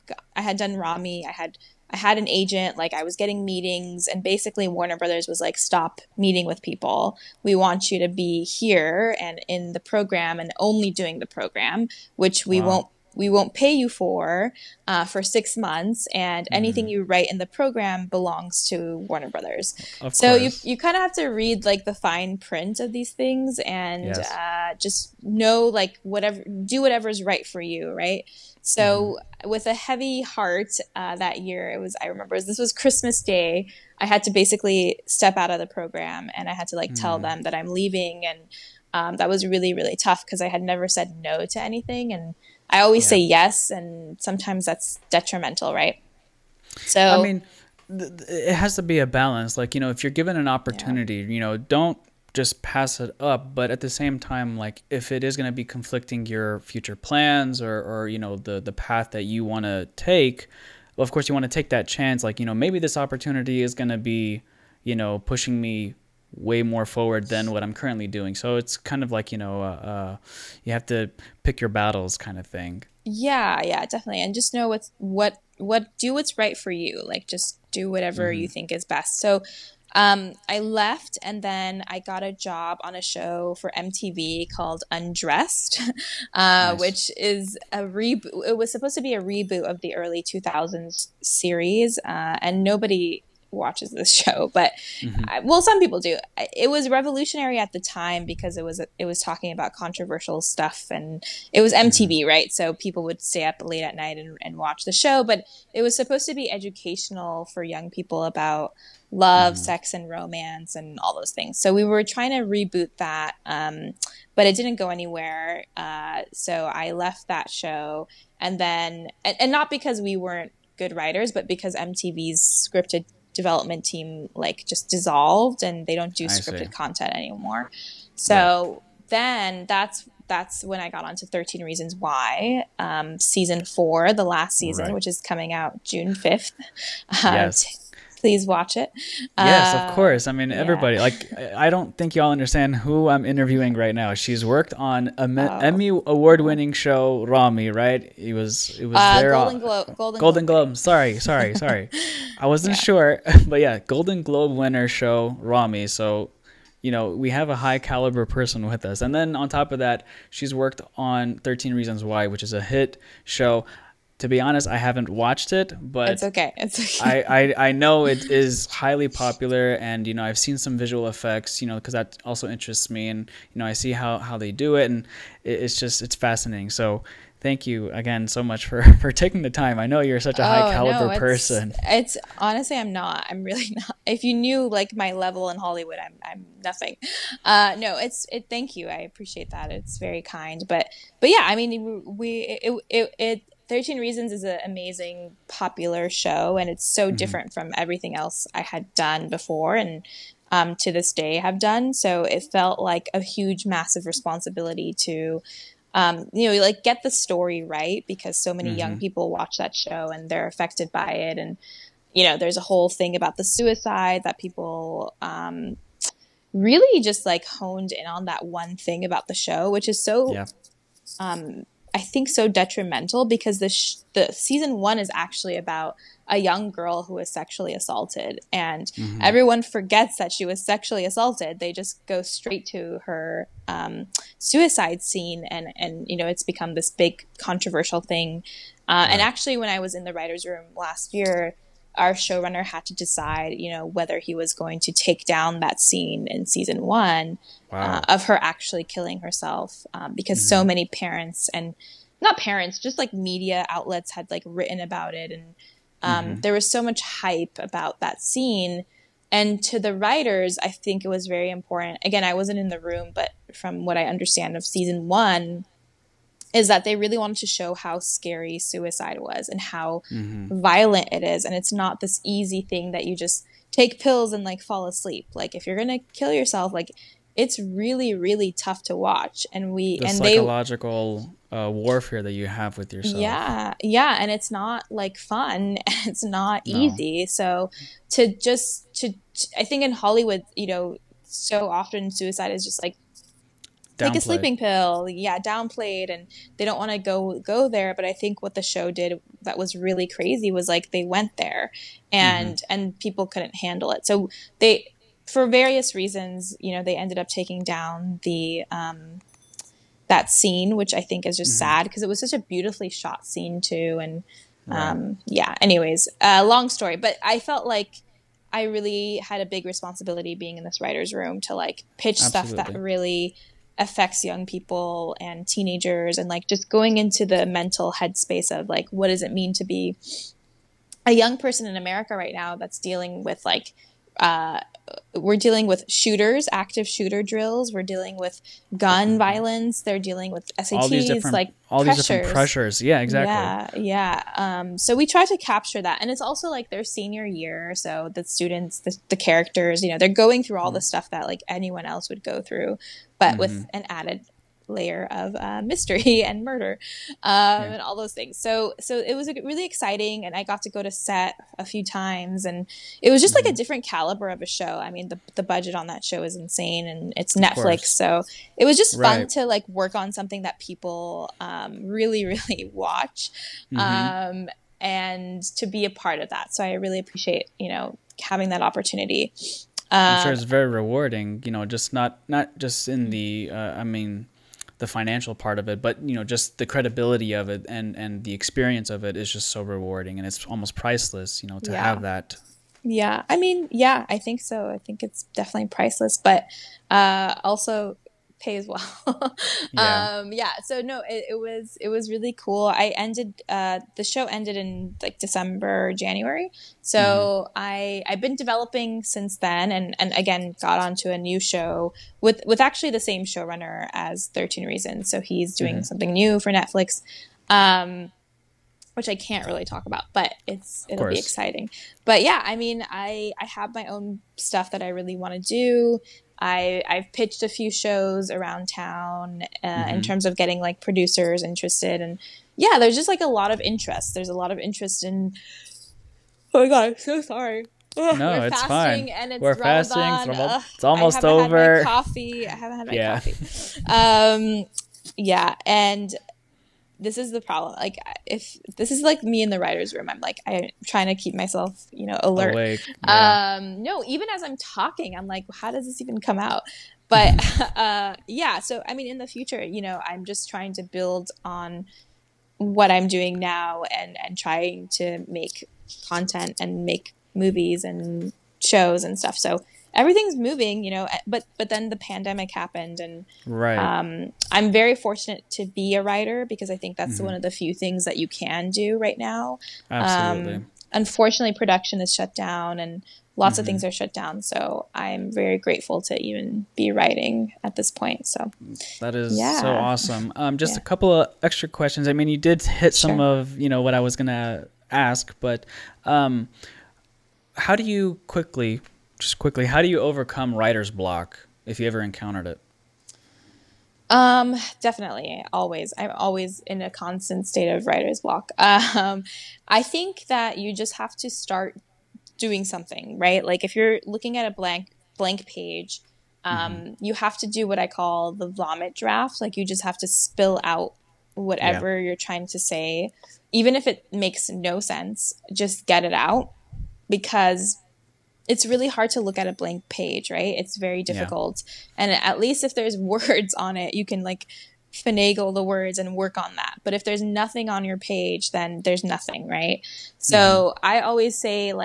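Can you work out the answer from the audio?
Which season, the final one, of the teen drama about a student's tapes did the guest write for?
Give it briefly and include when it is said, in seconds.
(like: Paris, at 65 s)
season four, at 133 s.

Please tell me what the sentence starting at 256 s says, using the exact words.
there was so much hype about that scene.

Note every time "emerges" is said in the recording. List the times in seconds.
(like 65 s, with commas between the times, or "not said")
not said.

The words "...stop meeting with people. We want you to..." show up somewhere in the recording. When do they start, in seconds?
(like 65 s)
5 s.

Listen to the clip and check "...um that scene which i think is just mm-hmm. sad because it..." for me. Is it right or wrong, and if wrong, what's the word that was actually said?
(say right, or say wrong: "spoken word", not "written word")
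right.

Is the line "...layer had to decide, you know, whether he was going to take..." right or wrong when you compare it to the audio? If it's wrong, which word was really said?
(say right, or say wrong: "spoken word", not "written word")
wrong: "showrunner", not "layer".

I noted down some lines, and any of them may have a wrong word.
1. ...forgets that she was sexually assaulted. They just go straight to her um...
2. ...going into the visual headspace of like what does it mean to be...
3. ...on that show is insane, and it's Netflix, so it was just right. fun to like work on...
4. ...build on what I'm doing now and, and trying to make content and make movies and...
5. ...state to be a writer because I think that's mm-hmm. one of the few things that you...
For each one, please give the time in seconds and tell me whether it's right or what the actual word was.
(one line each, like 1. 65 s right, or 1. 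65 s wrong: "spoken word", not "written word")
1. 229 s right
2. 326 s wrong: "mental", not "visual"
3. 365 s right
4. 460 s right
5. 474 s wrong: "fortunate", not "state".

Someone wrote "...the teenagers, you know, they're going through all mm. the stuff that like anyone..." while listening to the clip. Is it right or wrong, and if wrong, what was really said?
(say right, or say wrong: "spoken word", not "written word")
wrong: "characters", not "teenagers".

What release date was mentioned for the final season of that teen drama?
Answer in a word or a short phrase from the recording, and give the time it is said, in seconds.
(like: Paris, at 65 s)
June 5th, at 135 s.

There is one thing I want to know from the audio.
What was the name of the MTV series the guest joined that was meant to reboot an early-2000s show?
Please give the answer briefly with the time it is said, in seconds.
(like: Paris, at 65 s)
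Undressed, at 84 s.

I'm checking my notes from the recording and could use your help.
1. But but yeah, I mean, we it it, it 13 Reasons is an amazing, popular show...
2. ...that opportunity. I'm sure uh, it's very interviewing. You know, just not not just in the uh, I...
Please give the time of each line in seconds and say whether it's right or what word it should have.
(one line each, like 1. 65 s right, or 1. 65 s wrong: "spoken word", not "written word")
1. 190 s right
2. 378 s wrong: "rewarding", not "interviewing".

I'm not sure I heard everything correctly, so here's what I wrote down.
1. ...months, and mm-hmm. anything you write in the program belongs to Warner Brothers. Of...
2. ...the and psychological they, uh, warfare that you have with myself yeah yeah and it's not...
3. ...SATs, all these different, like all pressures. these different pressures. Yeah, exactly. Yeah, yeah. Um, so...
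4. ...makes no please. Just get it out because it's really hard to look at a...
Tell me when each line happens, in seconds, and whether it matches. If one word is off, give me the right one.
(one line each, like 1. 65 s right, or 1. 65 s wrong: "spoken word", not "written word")
1. 15 s right
2. 279 s wrong: "yourself", not "myself"
3. 340 s right
4. 524 s wrong: "sense", not "please".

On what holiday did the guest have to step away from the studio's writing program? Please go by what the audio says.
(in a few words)
Christmas Day.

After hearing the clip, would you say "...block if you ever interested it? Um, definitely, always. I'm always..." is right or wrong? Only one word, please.
wrong.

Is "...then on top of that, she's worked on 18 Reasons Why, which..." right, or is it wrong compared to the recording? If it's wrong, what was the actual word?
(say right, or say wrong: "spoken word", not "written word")
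wrong: "13", not "18".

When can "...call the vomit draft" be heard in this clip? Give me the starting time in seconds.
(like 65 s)
517 s.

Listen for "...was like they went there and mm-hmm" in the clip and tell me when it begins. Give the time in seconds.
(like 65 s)
300 s.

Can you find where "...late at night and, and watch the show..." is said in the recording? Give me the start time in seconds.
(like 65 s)
103 s.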